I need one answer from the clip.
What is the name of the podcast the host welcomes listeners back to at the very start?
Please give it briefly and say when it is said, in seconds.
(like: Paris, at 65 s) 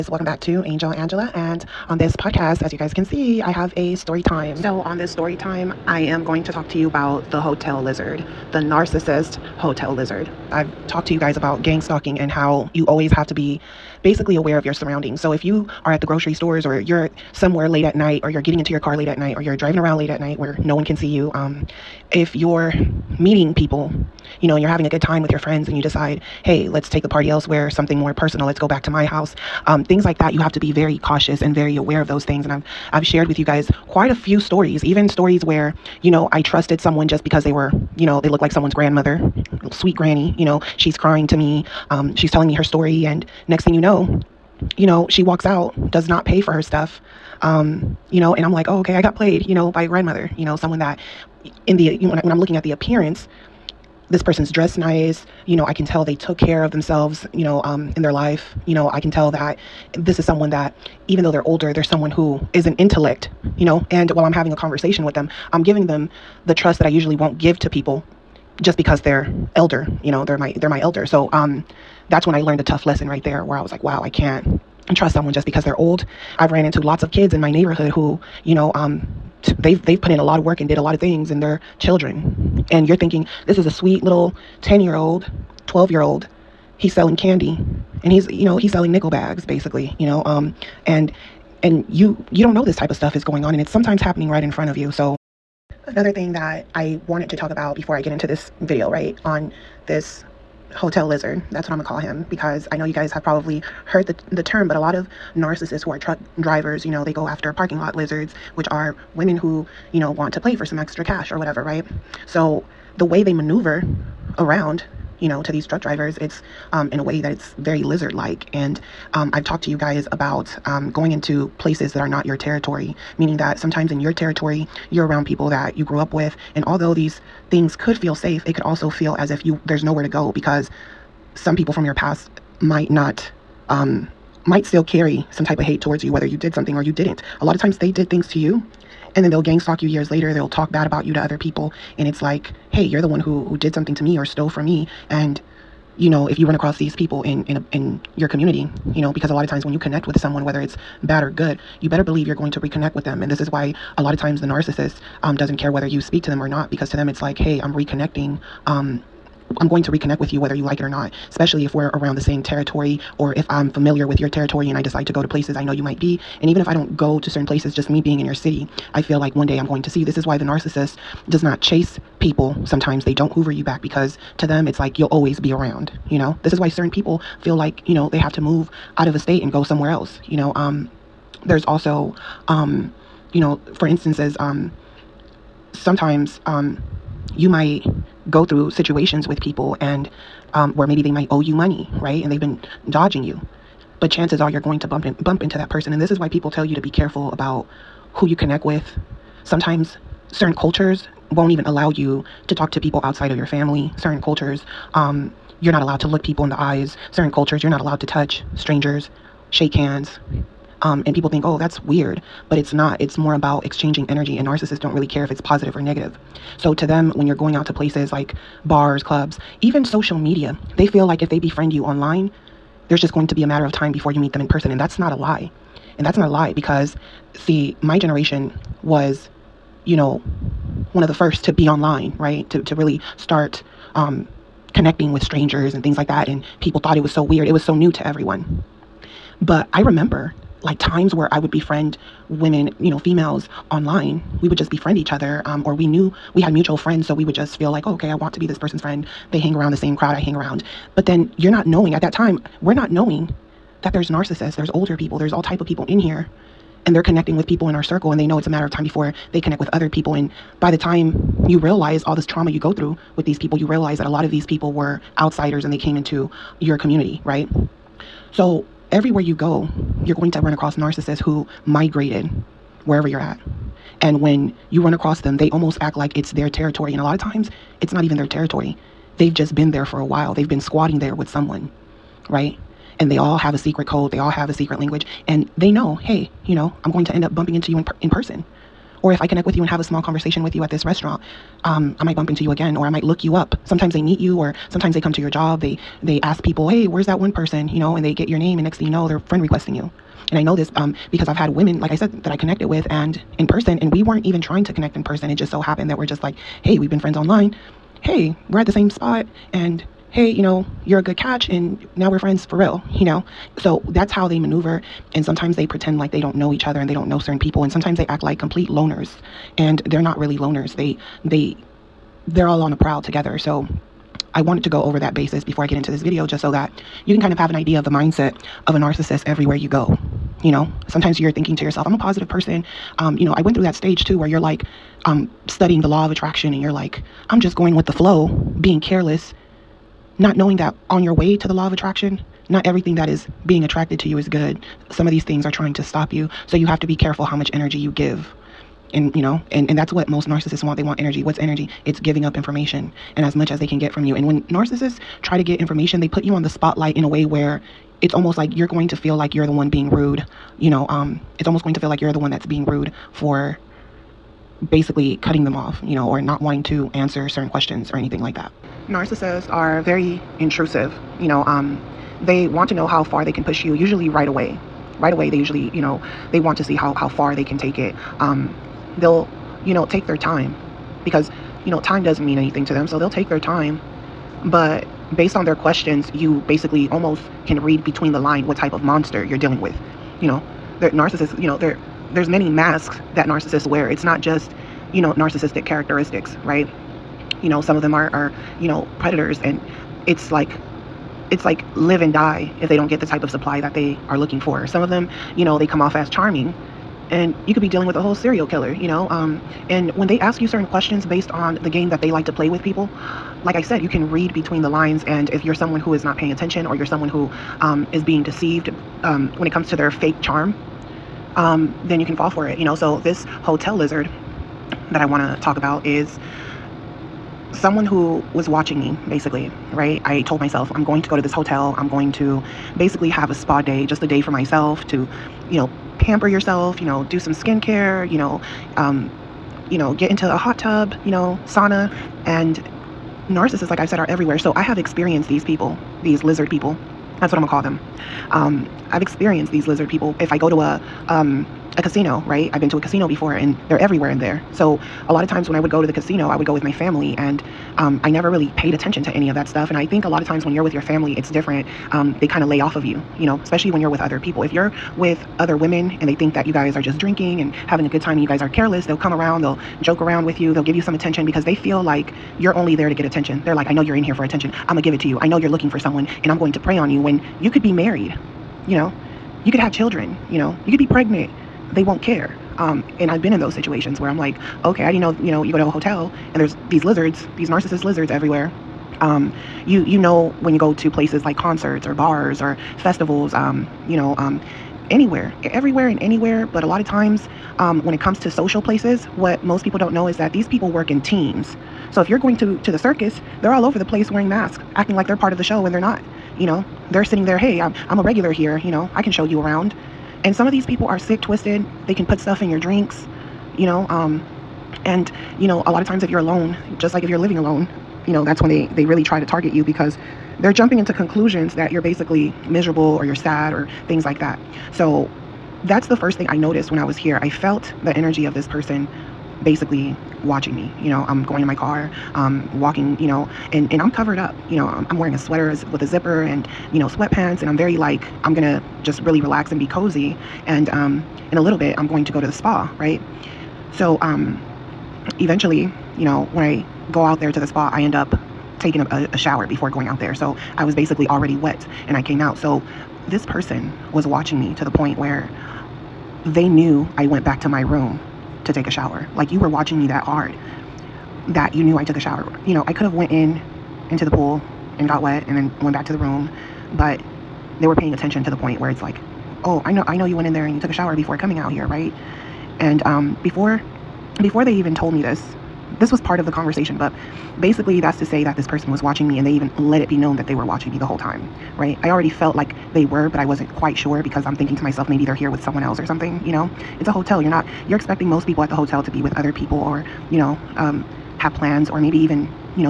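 Angel Angela, at 0 s.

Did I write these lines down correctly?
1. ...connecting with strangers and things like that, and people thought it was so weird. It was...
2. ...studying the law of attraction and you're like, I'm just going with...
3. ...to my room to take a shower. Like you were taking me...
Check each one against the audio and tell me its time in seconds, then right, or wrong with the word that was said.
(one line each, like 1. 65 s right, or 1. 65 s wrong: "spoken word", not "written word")
1. 234 s right
2. 335 s right
3. 557 s wrong: "watching", not "taking".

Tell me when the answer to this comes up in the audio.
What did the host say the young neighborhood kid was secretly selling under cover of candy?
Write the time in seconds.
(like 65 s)
88 s.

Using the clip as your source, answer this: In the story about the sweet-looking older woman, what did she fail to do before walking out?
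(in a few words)
pay for her stuff.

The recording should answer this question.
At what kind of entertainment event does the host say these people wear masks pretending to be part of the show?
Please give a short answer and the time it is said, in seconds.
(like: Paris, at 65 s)
circus, at 502 s.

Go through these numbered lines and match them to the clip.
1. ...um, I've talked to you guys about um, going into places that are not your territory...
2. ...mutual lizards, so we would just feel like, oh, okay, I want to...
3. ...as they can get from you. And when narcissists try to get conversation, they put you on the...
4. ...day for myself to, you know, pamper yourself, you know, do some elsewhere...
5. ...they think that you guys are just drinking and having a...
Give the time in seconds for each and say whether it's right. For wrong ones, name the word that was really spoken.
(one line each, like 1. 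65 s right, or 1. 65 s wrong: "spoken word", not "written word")
1. 119 s right
2. 246 s wrong: "friends", not "lizards"
3. 353 s wrong: "information", not "conversation"
4. 434 s wrong: "skincare", not "elsewhere"
5. 466 s right.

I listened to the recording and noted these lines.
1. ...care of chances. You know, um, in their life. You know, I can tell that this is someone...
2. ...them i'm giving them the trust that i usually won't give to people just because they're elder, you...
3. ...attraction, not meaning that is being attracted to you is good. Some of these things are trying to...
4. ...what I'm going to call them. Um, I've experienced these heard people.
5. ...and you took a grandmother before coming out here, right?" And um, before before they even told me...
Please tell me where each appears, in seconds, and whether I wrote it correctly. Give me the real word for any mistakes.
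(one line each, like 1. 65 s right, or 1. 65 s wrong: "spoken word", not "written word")
1. 56 s wrong: "themselves", not "chances"
2. 65 s right
3. 341 s wrong: "everything", not "meaning"
4. 447 s wrong: "lizard", not "heard"
5. 570 s wrong: "shower", not "grandmother".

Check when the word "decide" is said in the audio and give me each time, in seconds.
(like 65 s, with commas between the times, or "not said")
25 s, 164 s.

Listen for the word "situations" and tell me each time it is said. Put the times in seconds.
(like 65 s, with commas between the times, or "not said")
188 s, 483 s.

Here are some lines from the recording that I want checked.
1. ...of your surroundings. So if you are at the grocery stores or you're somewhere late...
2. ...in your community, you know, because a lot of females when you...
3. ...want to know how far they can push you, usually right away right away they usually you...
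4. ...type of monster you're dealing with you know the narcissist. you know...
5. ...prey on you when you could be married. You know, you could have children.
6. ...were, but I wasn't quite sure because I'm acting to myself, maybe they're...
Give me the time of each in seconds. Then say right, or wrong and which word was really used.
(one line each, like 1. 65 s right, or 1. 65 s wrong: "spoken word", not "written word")
1. 14 s right
2. 147 s wrong: "times", not "females"
3. 372 s right
4. 388 s right
5. 476 s right
6. 582 s wrong: "thinking", not "acting".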